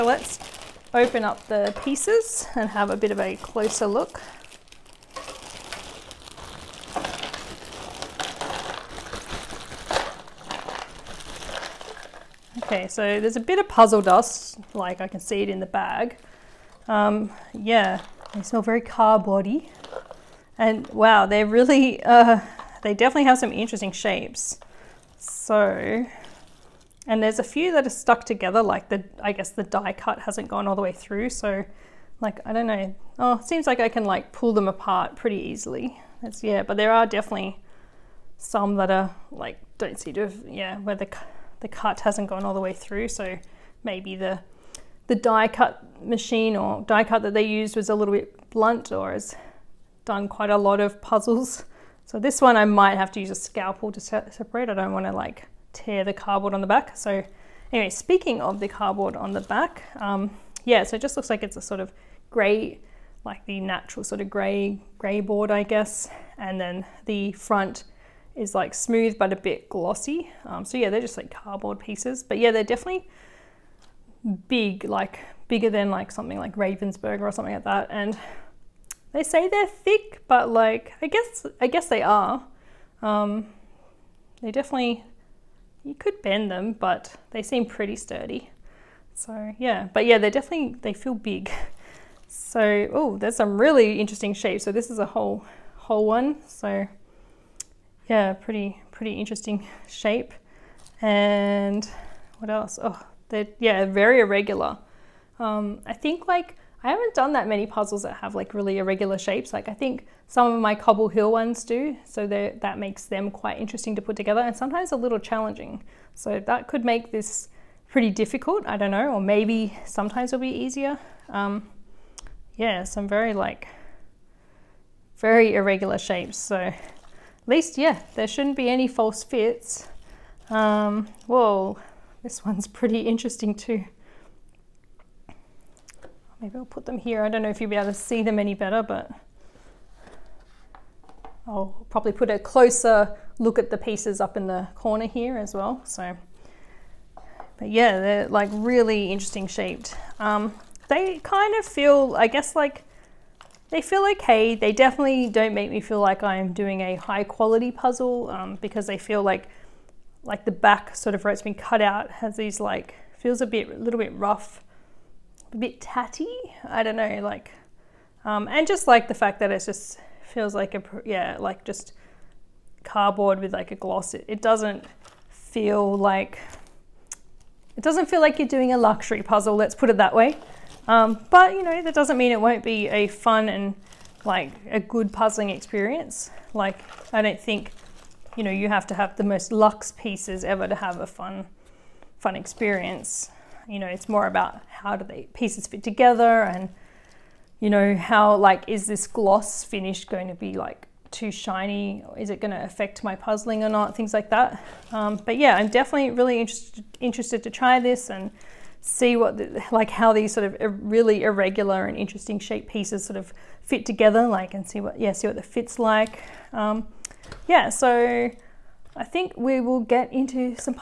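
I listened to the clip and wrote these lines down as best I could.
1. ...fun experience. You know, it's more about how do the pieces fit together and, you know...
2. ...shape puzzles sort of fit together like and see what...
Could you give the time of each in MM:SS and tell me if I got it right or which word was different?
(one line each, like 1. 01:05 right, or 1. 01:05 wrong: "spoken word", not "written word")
1. 03:12 right
2. 03:32 wrong: "pieces", not "puzzles".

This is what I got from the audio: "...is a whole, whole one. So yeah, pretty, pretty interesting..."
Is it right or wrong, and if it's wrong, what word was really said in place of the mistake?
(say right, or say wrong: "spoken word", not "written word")
right.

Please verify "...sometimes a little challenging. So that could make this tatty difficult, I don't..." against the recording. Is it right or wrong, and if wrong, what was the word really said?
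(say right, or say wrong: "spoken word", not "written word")
wrong: "pretty", not "tatty".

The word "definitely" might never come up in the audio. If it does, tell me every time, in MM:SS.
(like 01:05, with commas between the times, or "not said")
00:22, 00:37, 01:12, 01:24, 01:30, 02:34, 03:25.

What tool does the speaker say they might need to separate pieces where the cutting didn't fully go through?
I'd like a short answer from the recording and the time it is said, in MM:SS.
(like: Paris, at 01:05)
Scalpel, at 00:53.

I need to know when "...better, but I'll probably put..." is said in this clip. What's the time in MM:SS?
02:18.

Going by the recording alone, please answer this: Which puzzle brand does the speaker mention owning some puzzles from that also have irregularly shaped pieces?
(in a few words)
Cobble Hill.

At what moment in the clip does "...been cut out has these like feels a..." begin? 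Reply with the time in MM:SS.
02:41.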